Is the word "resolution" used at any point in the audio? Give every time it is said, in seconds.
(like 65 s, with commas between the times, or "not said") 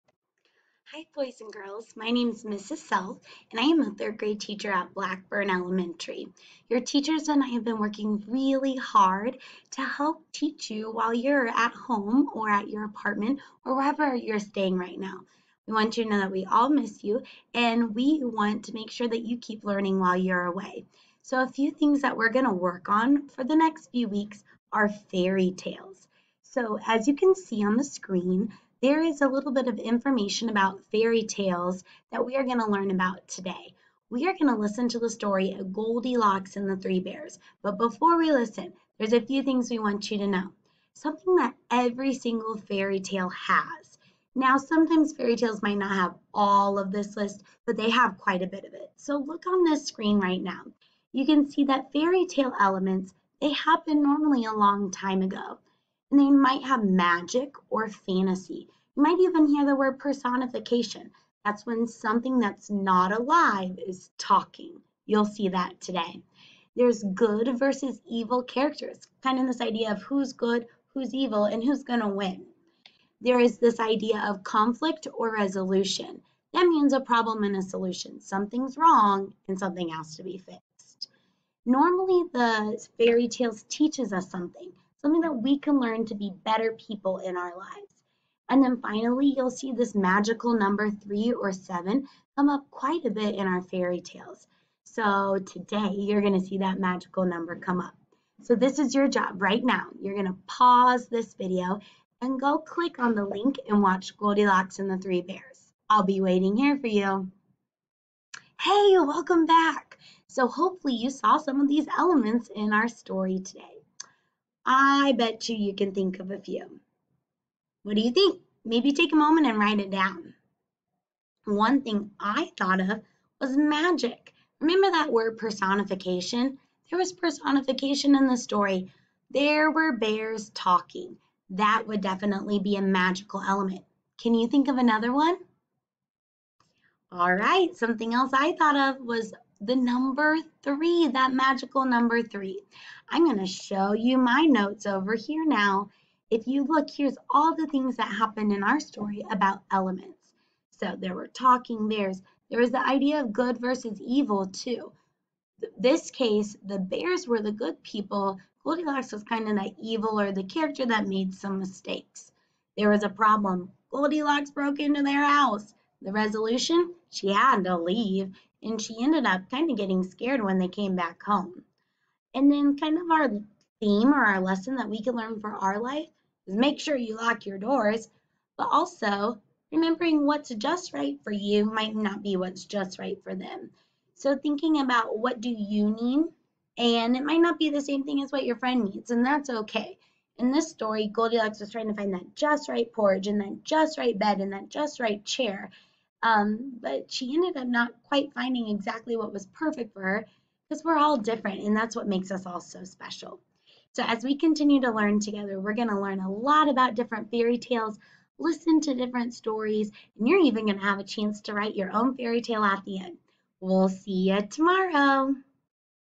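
75 s, 166 s.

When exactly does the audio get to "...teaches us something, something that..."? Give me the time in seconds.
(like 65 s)
83 s.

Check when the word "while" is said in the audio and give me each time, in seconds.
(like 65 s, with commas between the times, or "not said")
10 s, 19 s.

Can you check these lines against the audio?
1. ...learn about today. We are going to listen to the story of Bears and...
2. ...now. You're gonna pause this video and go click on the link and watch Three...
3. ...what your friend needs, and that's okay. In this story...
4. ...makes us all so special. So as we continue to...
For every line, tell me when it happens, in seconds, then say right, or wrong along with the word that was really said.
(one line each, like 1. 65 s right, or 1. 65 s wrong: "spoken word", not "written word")
1. 32 s wrong: "Goldilocks", not "Bears"
2. 99 s wrong: "Goldilocks", not "Three"
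3. 188 s right
4. 202 s right.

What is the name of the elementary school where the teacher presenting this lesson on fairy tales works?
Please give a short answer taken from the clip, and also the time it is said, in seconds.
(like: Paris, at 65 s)
Blackburn Elementary, at 4 s.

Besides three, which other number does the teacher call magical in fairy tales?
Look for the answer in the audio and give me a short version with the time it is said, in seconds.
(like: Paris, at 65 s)
7, at 91 s.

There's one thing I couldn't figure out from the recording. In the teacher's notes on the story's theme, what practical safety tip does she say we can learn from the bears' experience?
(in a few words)
lock your doors.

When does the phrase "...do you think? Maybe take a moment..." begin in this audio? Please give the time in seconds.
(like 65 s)
117 s.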